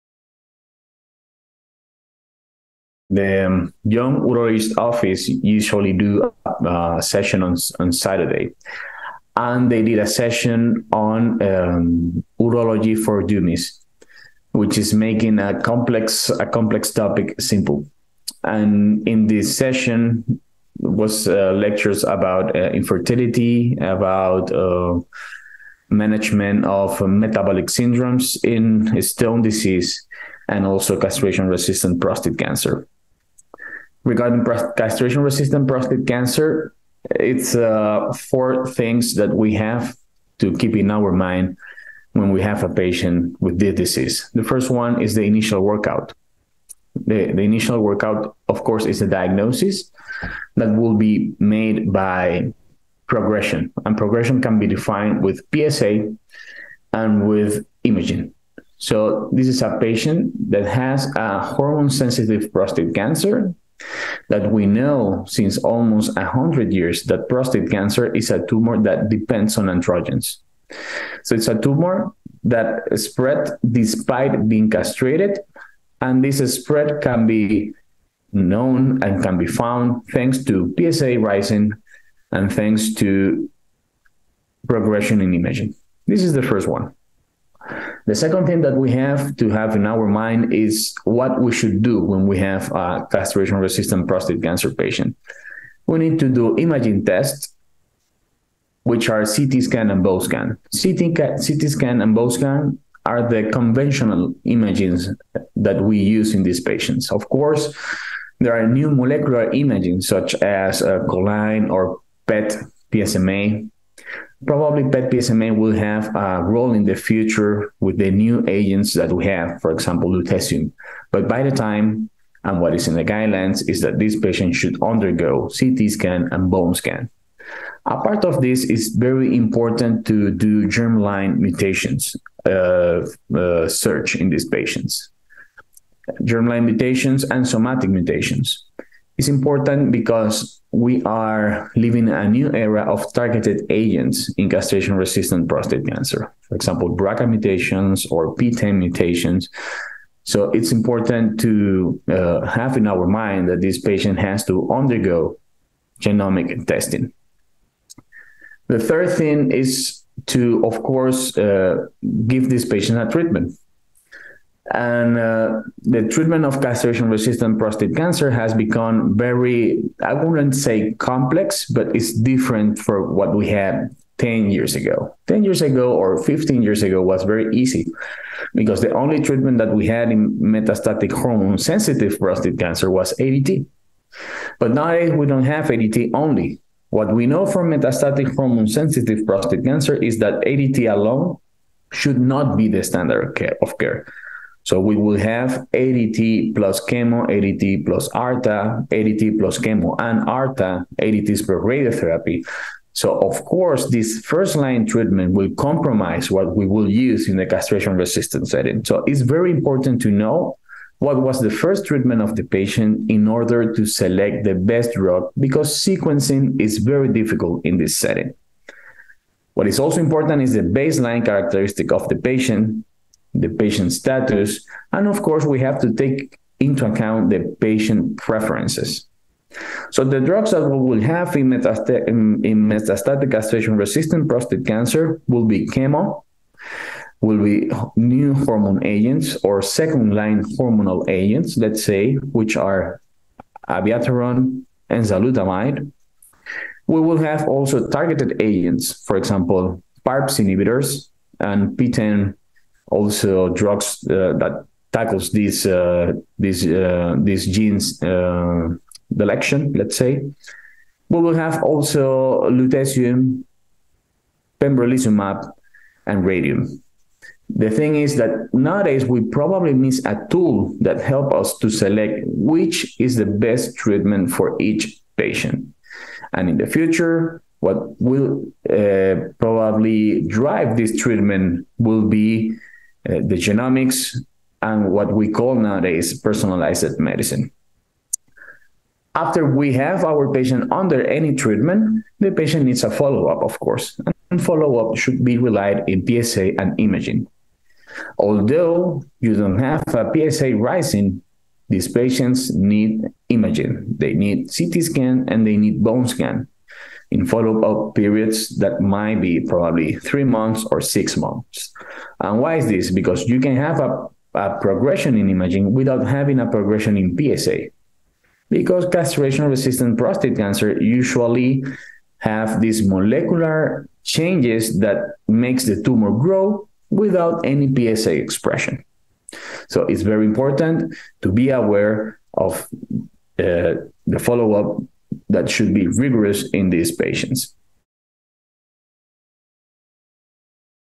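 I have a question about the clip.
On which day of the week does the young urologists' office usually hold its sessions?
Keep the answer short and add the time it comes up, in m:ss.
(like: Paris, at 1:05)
Saturday, at 0:07.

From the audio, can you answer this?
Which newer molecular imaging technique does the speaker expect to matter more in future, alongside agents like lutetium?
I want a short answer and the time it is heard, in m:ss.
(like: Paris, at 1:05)
PET-PSMA, at 1:54.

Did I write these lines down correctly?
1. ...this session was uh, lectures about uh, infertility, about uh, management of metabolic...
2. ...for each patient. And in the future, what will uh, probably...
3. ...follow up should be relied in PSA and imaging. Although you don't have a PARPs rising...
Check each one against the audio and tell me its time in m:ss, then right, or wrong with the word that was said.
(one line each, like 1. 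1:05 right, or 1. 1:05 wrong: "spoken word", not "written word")
1. 0:19 right
2. 4:34 right
3. 4:54 wrong: "PSA", not "PARPs".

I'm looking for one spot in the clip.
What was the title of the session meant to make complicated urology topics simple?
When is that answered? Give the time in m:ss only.
0:12.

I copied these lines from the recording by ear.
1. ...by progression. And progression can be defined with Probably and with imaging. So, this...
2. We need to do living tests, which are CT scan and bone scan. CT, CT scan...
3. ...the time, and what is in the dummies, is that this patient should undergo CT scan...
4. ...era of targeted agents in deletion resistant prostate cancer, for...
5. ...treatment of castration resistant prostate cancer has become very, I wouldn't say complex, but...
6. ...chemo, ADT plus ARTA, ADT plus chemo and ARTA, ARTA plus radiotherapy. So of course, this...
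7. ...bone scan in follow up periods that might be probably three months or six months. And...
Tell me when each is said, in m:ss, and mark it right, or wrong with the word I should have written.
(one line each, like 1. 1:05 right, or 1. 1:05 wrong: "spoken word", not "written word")
1. 0:51 wrong: "PSA", not "Probably"
2. 1:35 wrong: "imaging", not "living"
3. 2:01 wrong: "guidelines", not "dummies"
4. 2:22 wrong: "castration", not "deletion"
5. 2:46 right
6. 3:16 wrong: "ADTs", not "ARTA"
7. 5:05 right.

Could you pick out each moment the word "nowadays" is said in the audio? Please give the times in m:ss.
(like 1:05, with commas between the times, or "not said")
4:28, 4:45.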